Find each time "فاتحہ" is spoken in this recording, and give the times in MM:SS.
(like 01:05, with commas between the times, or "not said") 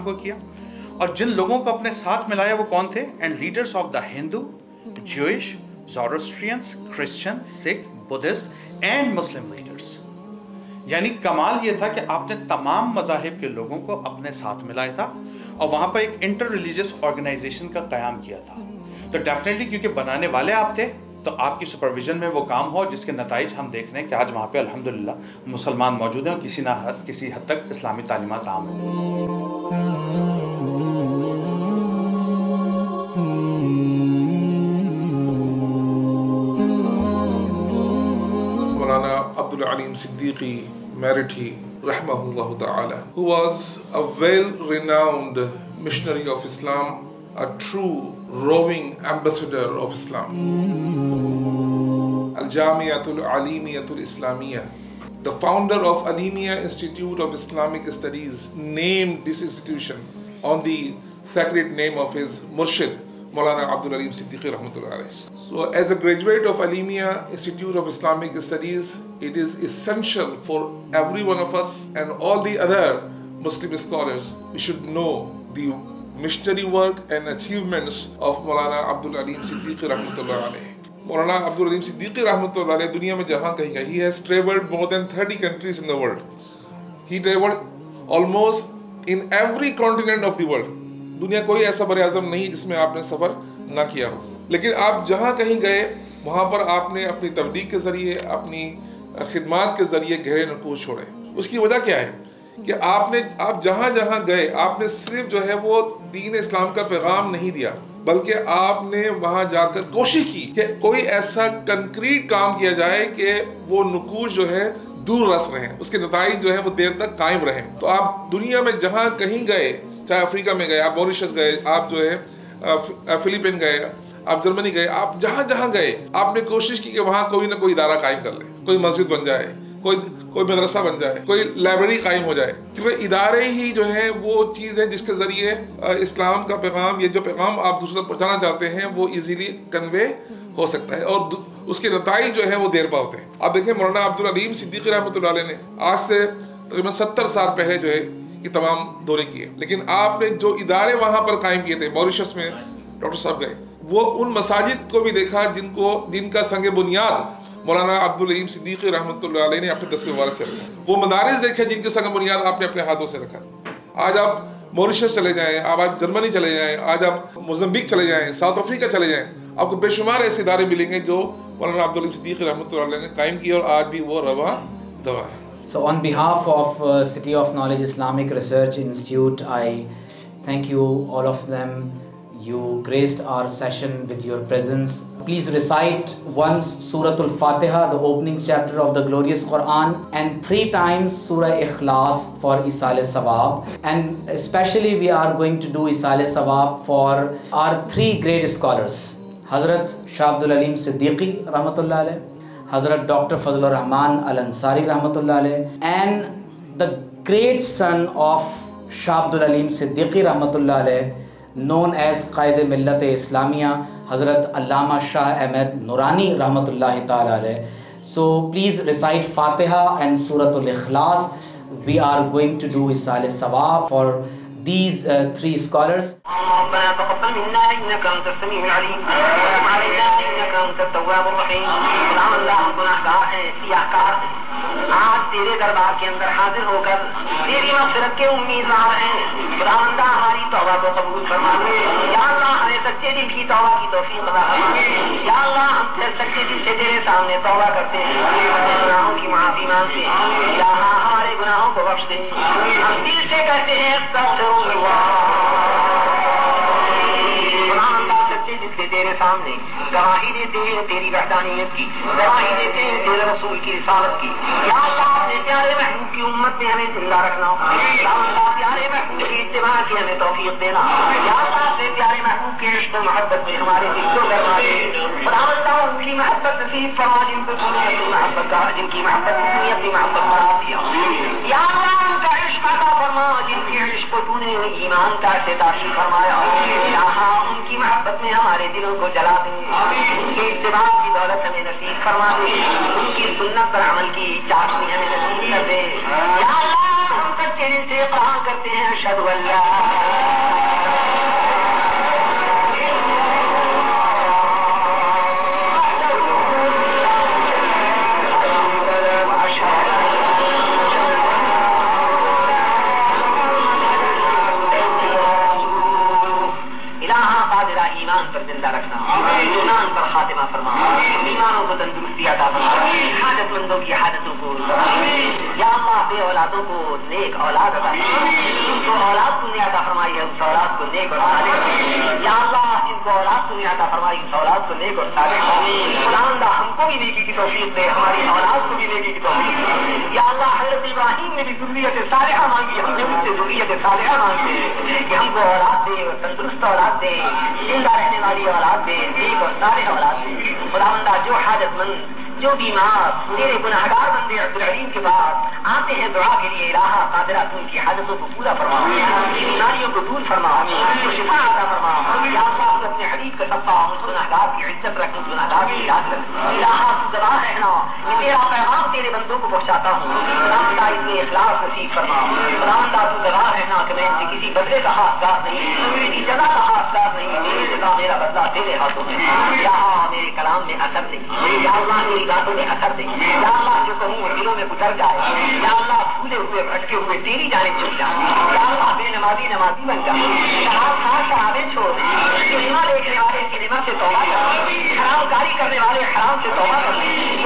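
03:39.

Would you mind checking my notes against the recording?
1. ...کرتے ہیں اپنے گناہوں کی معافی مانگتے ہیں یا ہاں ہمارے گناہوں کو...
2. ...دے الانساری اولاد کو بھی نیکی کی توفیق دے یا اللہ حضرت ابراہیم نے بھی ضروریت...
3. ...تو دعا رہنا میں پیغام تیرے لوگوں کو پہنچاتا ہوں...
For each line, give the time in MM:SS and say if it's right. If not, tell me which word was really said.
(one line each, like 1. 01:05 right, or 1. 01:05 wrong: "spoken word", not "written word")
1. 04:07 right
2. 05:37 wrong: "ہماری", not "الانساری"
3. 06:07 wrong: "بندوں", not "لوگوں".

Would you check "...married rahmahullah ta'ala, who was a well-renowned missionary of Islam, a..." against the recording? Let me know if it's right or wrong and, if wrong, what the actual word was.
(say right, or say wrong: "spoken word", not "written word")
right.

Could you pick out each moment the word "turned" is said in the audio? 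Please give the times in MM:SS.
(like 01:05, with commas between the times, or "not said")
not said.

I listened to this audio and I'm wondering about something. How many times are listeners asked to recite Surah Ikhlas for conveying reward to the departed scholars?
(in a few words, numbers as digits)
3.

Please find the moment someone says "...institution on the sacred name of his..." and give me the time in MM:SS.
00:59.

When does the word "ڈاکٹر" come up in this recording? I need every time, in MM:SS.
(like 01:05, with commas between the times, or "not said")
02:32, 03:23.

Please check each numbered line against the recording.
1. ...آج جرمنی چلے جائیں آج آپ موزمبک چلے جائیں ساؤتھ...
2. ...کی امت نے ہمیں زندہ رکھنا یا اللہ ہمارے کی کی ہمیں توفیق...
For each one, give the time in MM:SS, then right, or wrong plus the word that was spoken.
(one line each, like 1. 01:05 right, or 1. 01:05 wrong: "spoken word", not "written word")
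1. 02:45 right
2. 04:26 wrong: "پیارے", not "ہمارے".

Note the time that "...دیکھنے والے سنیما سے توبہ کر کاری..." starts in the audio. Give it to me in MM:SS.
06:32.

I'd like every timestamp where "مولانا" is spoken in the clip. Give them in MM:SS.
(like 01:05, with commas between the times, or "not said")
02:23, 02:37, 02:51.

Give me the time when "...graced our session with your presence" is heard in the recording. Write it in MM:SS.
03:02.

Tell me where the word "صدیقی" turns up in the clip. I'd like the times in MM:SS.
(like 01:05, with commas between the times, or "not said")
02:24, 02:38, 02:52, 03:29.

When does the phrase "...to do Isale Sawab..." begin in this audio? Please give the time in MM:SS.
03:15.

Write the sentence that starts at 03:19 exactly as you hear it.
Hazrat Shah Abdul Alim Siddiqui, Rahmatullah alayhi.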